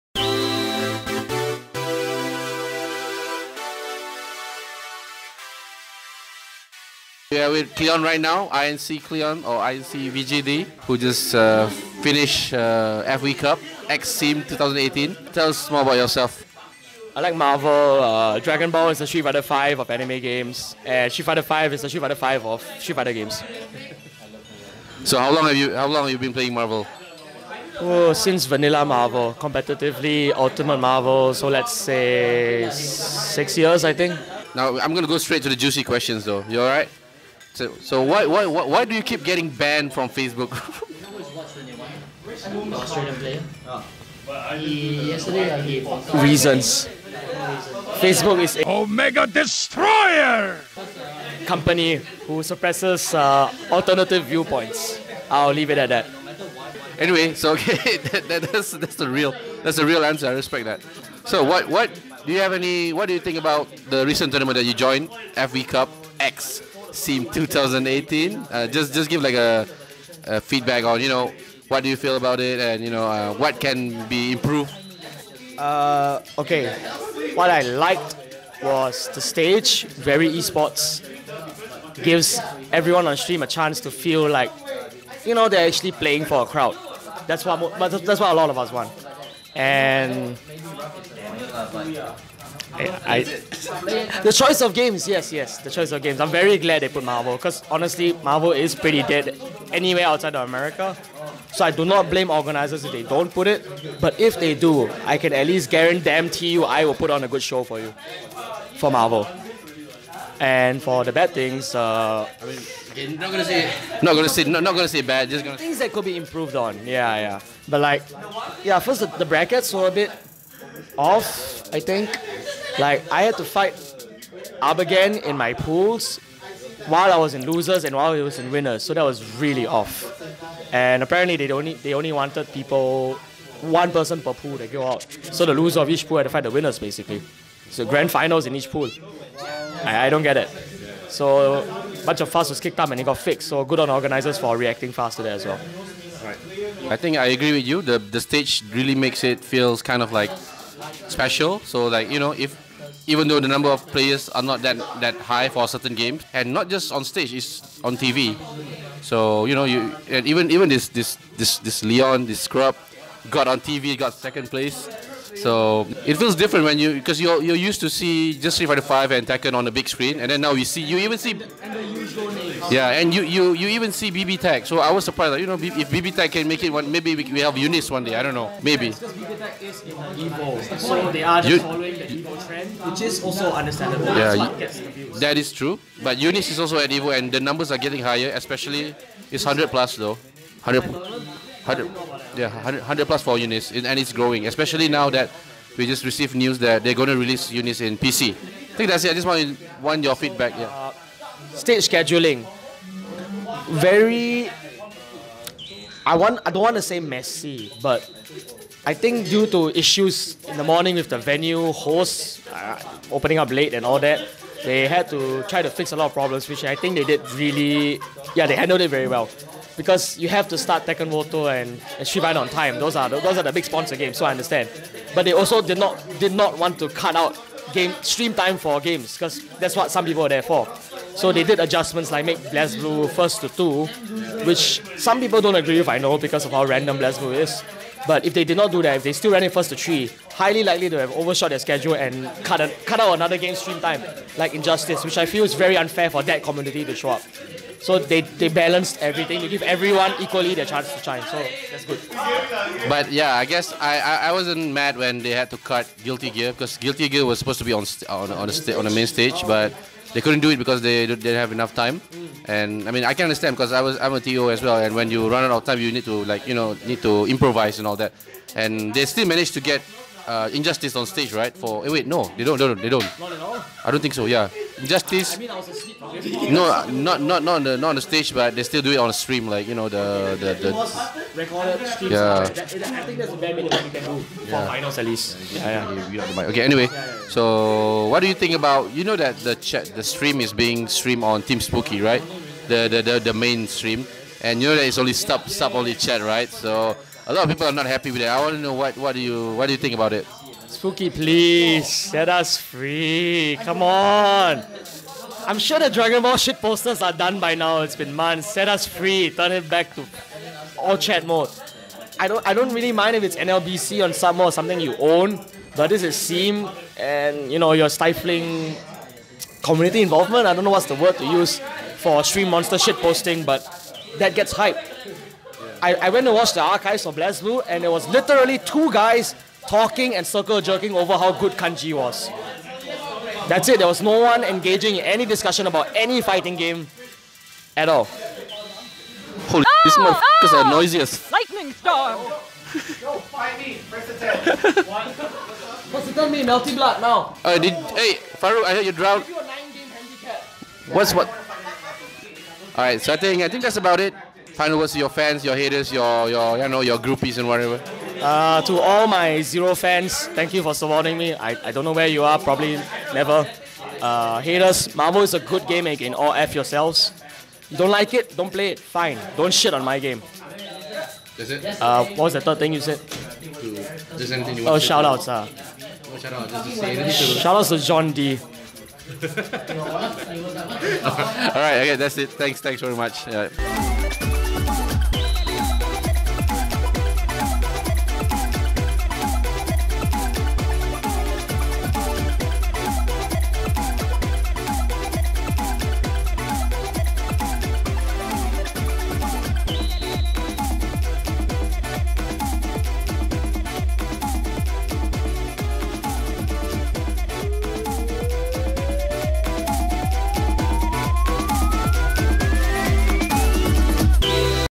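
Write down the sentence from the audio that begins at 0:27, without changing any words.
Oh, since Vanilla Marvel, competitively Ultimate Marvel, so let's say six years, I think.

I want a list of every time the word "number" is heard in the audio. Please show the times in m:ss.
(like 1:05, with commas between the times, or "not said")
2:33, 3:07.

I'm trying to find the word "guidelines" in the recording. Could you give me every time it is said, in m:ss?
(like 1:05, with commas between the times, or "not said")
not said.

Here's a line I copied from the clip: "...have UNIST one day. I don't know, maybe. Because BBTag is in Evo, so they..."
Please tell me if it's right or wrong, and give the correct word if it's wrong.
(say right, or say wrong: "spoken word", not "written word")
right.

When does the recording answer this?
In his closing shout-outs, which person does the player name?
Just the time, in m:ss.
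6:17.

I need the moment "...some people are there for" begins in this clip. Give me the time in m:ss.
3:49.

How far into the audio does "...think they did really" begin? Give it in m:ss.
3:36.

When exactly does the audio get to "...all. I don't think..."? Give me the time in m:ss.
4:33.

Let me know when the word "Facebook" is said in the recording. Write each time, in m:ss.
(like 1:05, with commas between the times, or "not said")
0:40, 0:47.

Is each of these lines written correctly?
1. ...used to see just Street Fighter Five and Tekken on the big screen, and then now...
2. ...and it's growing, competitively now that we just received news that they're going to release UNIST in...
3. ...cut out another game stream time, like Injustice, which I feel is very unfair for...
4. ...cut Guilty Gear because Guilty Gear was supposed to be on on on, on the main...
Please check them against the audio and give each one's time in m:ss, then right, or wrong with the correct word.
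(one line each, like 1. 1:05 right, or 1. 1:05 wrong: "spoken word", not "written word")
1. 2:47 right
2. 3:13 wrong: "especially", not "competitively"
3. 4:02 right
4. 4:15 right.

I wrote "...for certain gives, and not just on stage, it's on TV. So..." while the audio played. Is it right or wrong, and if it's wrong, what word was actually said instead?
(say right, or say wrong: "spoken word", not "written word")
wrong: "games", not "gives".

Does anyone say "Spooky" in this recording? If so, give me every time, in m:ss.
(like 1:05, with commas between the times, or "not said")
4:51, 5:00.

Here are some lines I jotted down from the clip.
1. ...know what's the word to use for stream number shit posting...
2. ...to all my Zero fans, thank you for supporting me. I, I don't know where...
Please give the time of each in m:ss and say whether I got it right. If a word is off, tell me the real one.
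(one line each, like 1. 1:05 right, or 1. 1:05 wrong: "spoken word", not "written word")
1. 5:20 wrong: "monster", not "number"
2. 5:58 right.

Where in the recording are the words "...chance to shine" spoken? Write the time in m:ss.
4:10.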